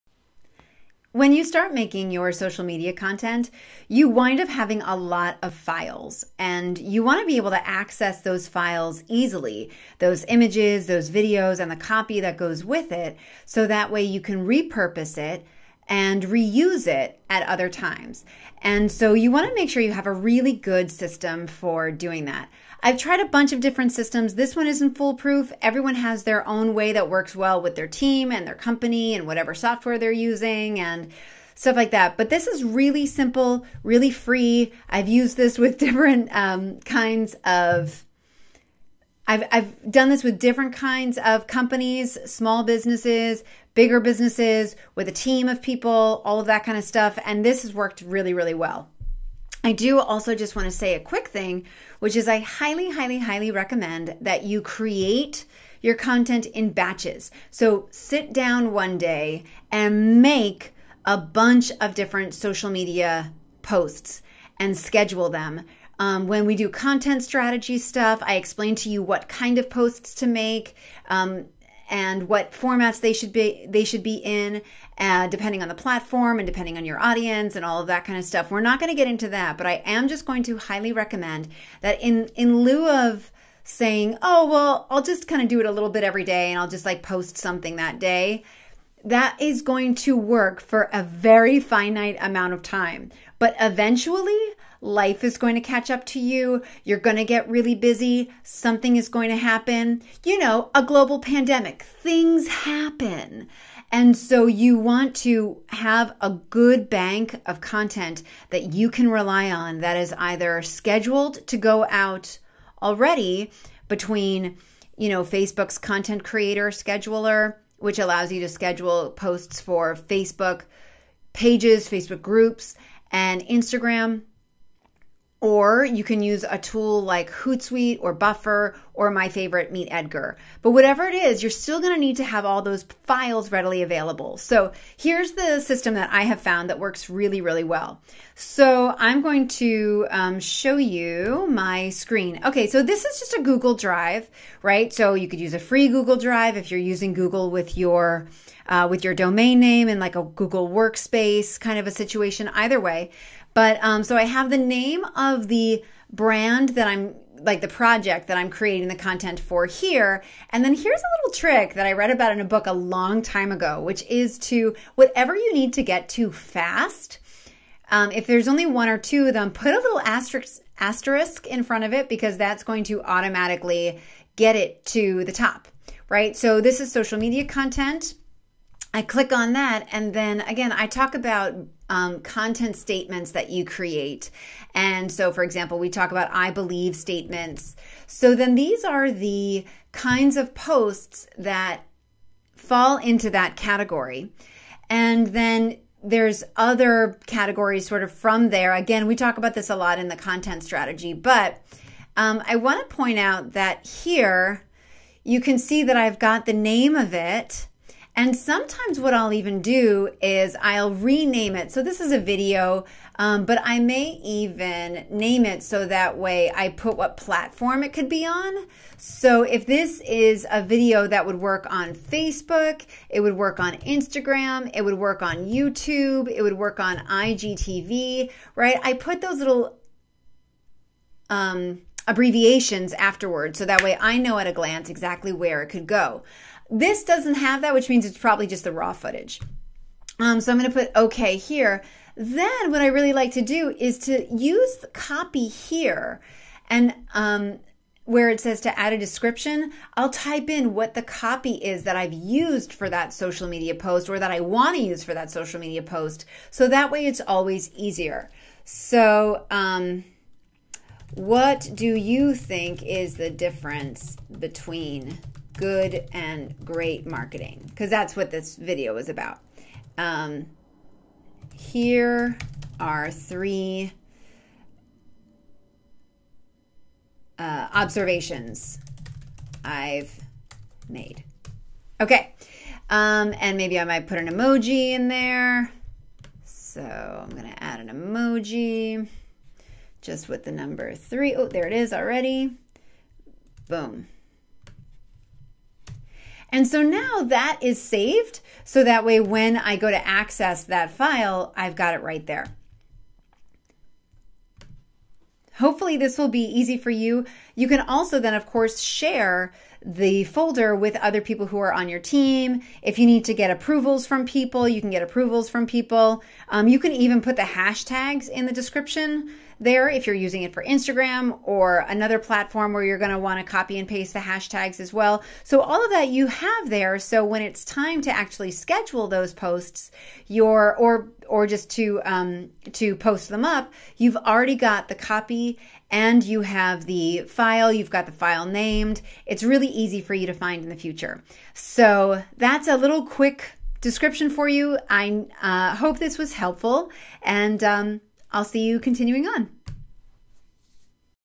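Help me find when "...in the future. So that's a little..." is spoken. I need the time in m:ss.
5:40.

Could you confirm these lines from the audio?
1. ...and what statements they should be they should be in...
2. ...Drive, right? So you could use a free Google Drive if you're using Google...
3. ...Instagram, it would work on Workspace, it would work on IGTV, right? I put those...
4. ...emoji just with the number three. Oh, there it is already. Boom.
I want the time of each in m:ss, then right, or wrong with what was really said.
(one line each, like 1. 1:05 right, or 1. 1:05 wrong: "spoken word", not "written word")
1. 1:11 wrong: "formats", not "statements"
2. 2:23 right
3. 3:43 wrong: "YouTube", not "Workspace"
4. 4:47 right.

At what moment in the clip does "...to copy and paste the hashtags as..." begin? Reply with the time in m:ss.
5:23.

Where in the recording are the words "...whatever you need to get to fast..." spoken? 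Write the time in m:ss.
2:44.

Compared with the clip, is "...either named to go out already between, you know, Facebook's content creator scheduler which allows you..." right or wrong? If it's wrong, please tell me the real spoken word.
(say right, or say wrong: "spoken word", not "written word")
wrong: "scheduled", not "named".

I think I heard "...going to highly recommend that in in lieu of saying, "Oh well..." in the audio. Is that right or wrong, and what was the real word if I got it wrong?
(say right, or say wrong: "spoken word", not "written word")
right.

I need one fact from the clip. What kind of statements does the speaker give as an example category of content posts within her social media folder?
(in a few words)
I believe statements.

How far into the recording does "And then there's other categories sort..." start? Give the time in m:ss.
3:14.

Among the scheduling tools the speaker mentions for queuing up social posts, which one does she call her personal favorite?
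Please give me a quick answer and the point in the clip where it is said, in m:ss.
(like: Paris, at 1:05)
MeetEdgar, at 2:09.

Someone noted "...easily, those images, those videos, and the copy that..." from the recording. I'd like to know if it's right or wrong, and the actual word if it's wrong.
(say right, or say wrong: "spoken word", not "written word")
right.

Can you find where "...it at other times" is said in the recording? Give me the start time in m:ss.
0:16.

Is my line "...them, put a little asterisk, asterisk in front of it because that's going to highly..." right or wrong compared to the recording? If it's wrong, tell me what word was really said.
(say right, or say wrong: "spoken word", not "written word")
wrong: "automatically", not "highly".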